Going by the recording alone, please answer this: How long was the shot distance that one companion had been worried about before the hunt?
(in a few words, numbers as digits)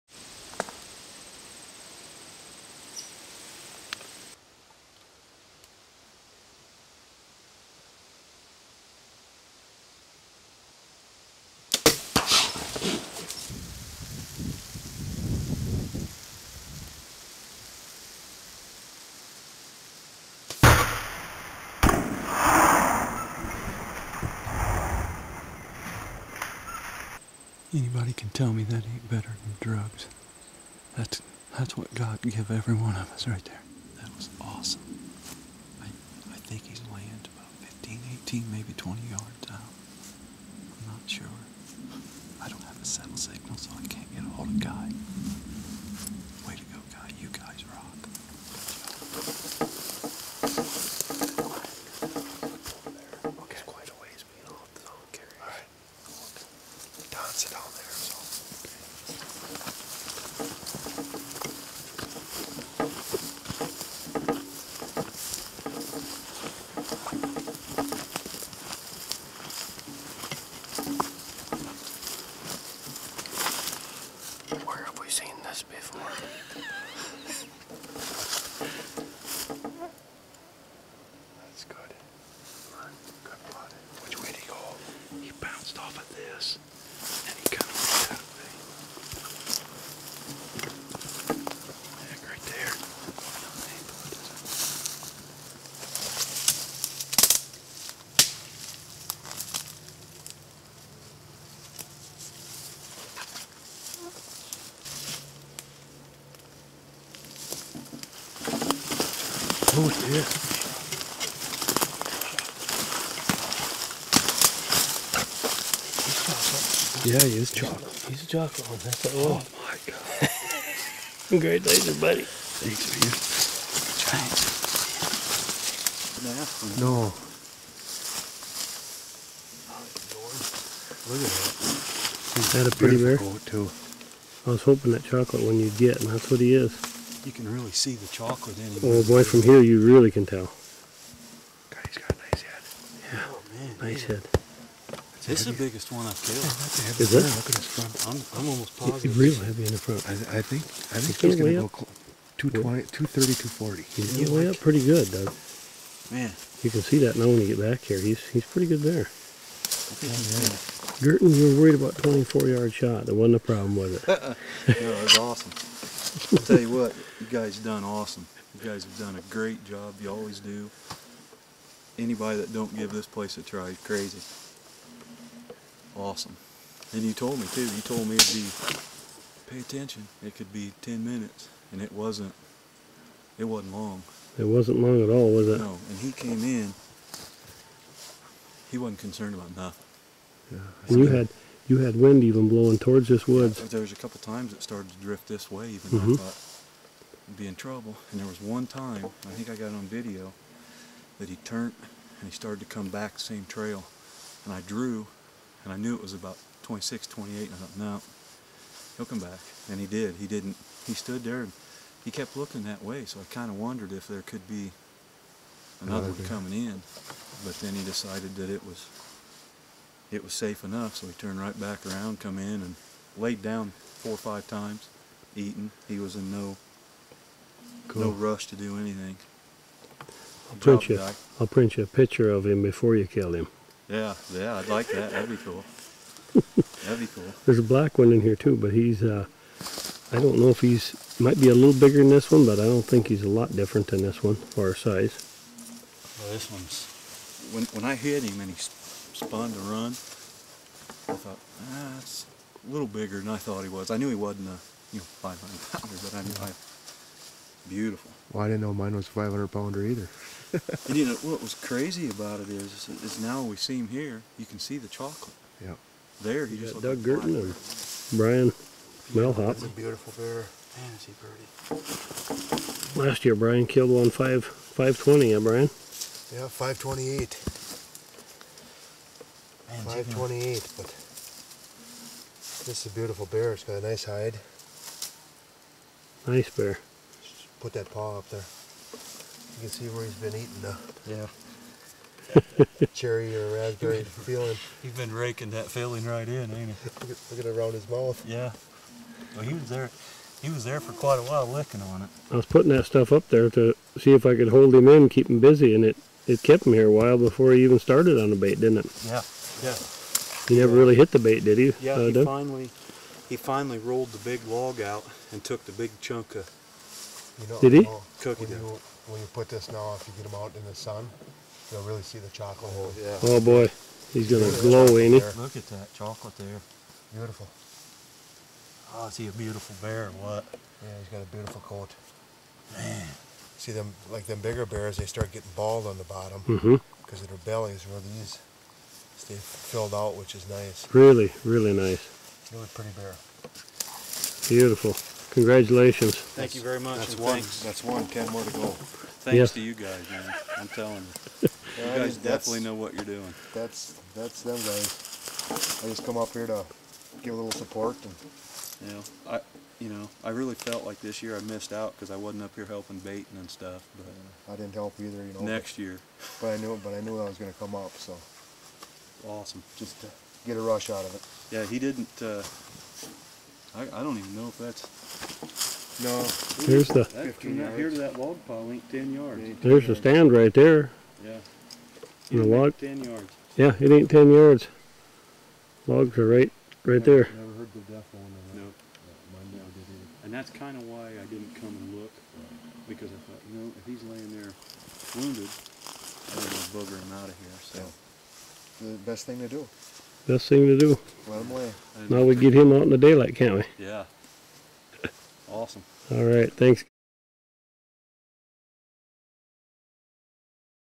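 24 yards.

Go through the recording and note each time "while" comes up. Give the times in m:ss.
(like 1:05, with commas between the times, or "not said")
5:01, 5:06.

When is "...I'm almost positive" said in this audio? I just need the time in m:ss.
2:28.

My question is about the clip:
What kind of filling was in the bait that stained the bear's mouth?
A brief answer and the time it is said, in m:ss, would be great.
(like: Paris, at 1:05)
Cherry or raspberry, at 4:52.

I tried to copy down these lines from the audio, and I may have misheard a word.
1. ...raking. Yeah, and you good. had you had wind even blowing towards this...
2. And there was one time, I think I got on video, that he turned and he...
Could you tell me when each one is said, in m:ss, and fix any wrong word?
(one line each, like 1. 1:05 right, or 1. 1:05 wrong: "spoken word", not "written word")
1. 3:09 wrong: "nothing", not "raking"
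2. 3:18 right.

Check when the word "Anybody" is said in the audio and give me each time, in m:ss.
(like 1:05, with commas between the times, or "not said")
0:27, 2:51.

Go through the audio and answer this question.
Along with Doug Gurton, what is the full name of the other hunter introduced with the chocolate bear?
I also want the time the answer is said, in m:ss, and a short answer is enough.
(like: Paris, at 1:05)
Brian Melhop, at 4:28.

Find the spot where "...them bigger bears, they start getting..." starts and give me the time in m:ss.
5:34.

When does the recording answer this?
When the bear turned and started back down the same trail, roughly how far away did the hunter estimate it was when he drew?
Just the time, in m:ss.
3:26.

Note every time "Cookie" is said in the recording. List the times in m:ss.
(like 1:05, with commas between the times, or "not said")
5:18.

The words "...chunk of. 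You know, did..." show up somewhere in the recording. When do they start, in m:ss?
5:16.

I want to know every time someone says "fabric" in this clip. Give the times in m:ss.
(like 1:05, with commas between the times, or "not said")
not said.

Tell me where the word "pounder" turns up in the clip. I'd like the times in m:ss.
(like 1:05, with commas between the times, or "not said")
4:15, 4:19.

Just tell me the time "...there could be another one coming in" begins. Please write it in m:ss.
3:34.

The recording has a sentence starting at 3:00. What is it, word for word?
It could be 10 minutes, and it wasn't.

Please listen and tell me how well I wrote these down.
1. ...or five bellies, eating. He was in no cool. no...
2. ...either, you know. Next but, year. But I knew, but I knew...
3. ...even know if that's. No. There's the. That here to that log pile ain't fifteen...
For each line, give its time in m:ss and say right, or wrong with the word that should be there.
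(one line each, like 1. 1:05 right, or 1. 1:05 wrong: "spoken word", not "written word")
1. 3:44 wrong: "times", not "bellies"
2. 6:04 right
3. 6:14 wrong: "ten", not "fifteen".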